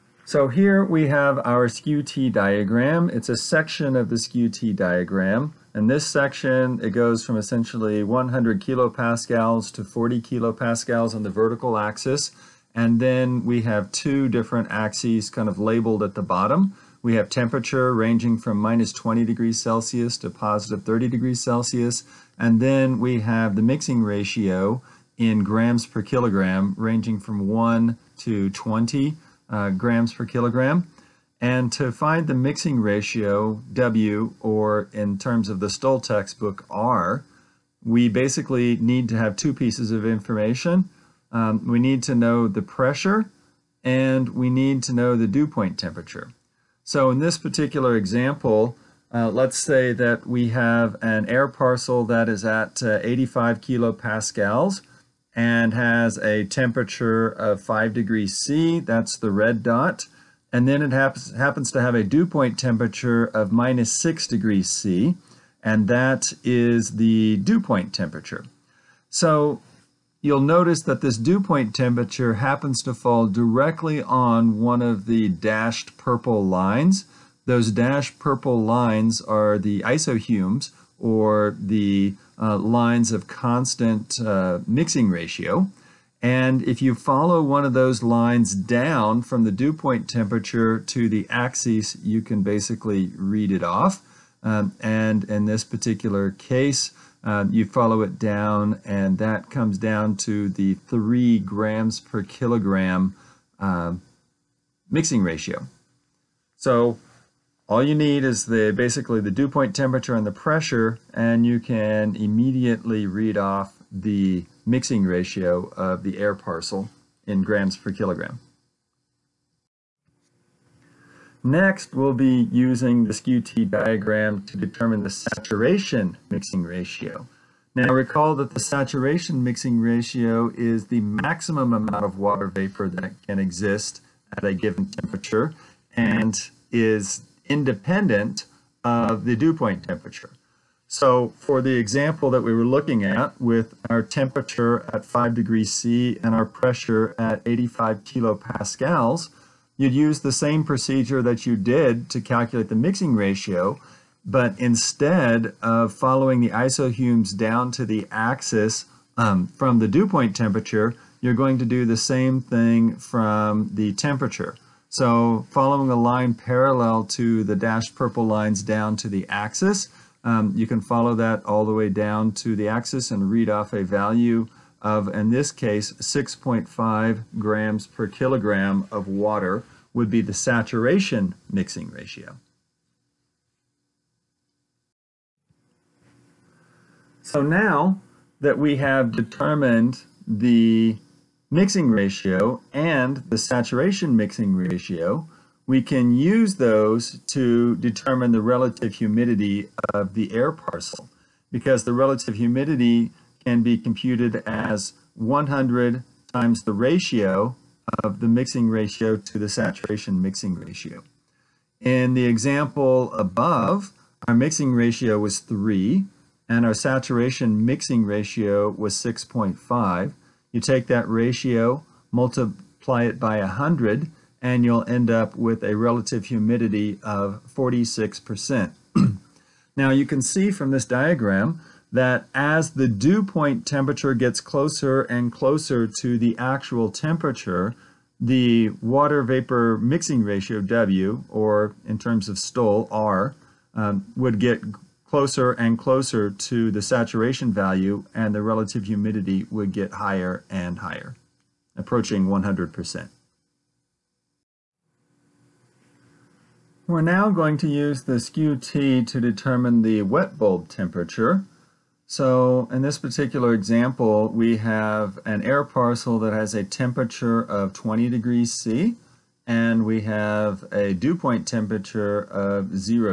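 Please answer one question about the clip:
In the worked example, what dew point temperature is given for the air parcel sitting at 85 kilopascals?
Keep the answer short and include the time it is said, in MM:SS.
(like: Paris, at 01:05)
-6 degrees C, at 01:03.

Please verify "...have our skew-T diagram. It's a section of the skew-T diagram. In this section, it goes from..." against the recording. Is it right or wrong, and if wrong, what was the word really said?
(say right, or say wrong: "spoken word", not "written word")
right.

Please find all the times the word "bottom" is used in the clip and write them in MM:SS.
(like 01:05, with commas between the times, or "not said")
00:16.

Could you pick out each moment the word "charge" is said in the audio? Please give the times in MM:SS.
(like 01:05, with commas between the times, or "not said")
not said.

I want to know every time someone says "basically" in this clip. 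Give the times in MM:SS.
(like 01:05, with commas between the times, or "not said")
00:38, 01:32, 01:48.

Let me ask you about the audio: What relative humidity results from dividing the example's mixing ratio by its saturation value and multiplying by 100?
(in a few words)
46%.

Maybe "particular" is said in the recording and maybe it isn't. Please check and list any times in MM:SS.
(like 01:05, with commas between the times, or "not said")
00:47, 01:35, 04:22.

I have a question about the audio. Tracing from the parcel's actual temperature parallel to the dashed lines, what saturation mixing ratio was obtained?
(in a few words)
6.5 grams per kilogram.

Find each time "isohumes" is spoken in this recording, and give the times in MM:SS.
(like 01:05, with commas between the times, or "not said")
01:19, 02:36.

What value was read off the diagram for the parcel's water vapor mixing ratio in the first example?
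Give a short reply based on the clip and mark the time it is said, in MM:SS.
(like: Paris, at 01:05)
3 grams per kilogram, at 01:40.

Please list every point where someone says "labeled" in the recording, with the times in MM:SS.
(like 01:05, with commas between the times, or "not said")
00:15.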